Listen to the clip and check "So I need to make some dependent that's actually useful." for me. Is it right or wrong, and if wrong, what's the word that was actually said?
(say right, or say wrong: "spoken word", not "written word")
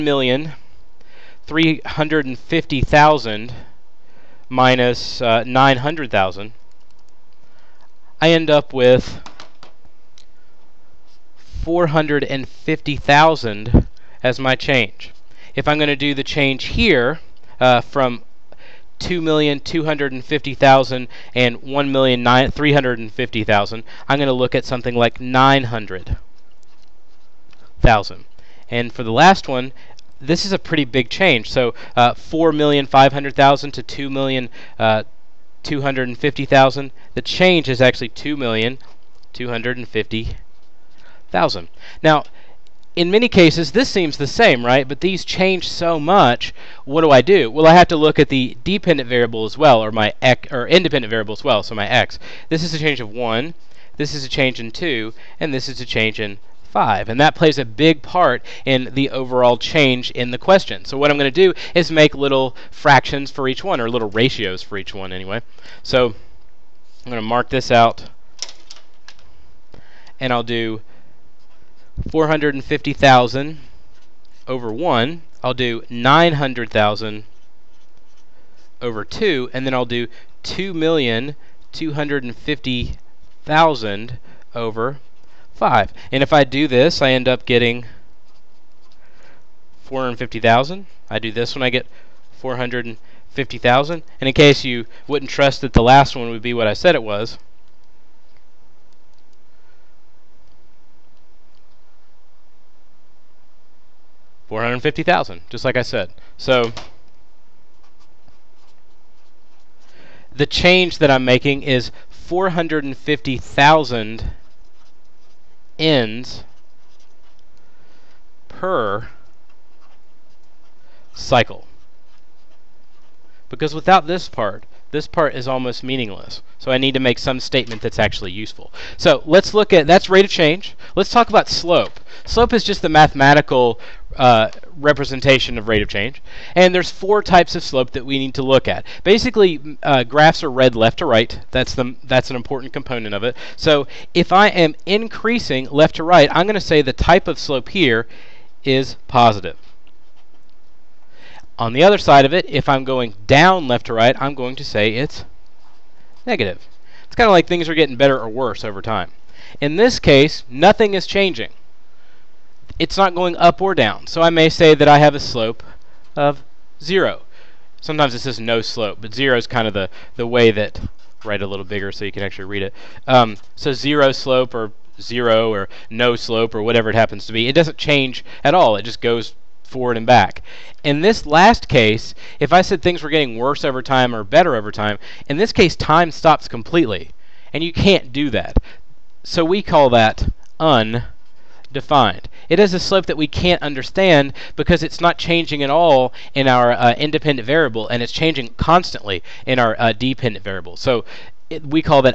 wrong: "statement", not "dependent".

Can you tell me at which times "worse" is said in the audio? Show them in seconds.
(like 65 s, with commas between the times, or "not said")
158 s, 183 s.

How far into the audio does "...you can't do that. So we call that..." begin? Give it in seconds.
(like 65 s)
187 s.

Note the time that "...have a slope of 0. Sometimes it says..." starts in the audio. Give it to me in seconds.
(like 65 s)
164 s.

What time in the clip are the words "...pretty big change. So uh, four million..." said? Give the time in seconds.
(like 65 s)
30 s.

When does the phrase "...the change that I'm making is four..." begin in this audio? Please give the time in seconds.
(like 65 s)
110 s.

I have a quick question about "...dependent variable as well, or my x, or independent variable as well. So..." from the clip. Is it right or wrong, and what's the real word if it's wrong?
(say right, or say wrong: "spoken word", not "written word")
right.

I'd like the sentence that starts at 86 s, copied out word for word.
And if I do this, I end up getting 450,000.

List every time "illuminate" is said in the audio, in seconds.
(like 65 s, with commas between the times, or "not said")
not said.